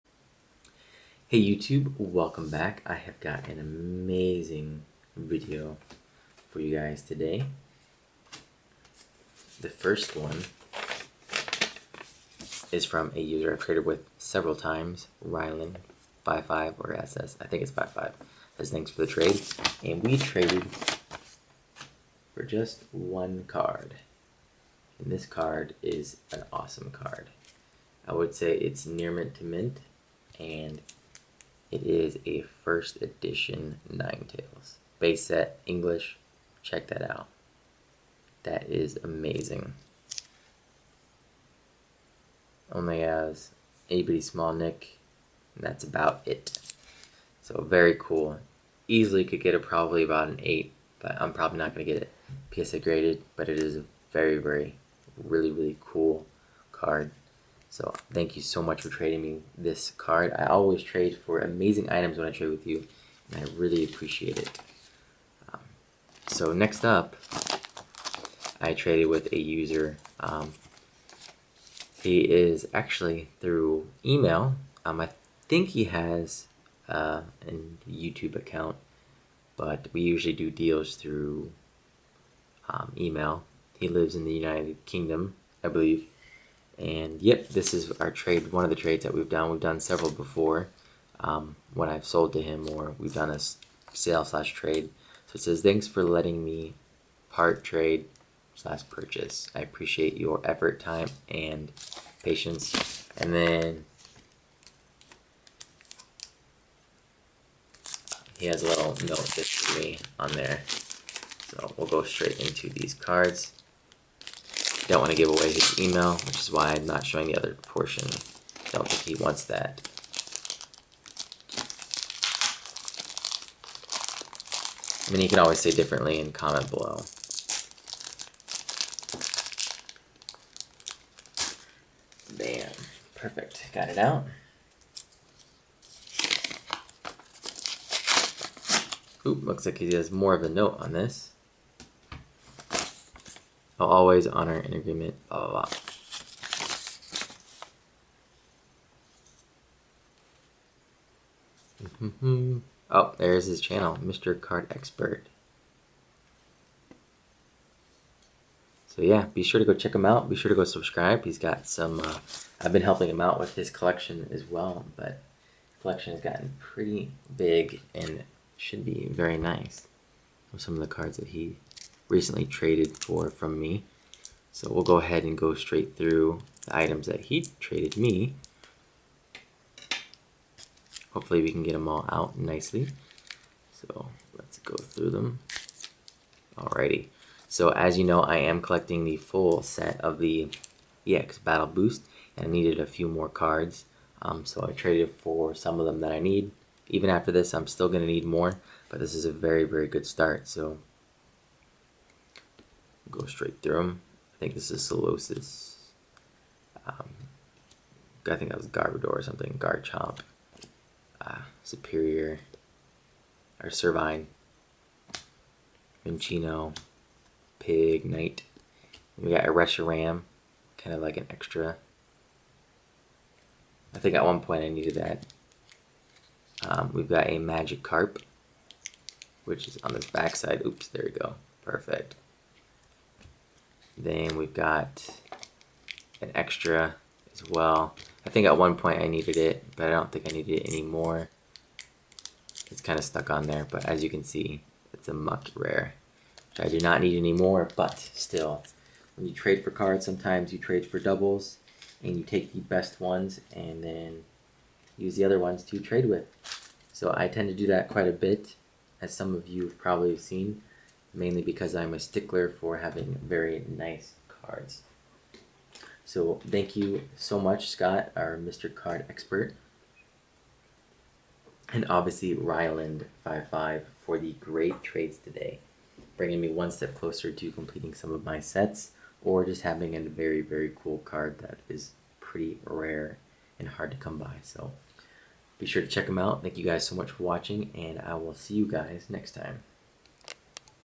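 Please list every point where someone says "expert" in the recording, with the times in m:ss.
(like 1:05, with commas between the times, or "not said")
2:34, 4:29.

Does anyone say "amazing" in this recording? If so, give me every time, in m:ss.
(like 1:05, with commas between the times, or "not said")
0:03, 0:39, 1:01.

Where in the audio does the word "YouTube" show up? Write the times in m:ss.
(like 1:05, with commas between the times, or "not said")
0:01, 1:17.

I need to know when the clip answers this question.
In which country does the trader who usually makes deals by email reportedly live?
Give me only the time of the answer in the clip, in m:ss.
1:24.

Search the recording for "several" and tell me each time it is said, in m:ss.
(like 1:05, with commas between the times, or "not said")
0:14, 1:29.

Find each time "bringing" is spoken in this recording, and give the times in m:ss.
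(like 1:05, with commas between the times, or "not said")
4:36.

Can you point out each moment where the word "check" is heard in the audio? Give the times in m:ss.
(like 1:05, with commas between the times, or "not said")
0:36, 2:39, 4:45.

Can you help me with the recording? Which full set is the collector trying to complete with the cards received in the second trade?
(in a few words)
EX Battle Boost.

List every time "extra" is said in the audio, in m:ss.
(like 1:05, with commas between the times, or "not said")
3:41, 3:56.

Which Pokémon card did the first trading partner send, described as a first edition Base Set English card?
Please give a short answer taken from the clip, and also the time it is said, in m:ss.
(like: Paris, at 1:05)
Ninetales, at 0:33.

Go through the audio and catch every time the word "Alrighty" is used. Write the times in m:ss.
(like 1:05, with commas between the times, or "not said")
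3:06.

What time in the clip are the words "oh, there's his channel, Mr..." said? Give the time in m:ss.
2:32.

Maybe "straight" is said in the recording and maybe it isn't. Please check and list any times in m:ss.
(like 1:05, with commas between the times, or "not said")
1:52, 2:55, 3:23.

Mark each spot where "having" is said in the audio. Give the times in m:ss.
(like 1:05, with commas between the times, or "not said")
4:22, 4:39.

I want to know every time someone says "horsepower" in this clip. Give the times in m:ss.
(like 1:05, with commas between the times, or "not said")
not said.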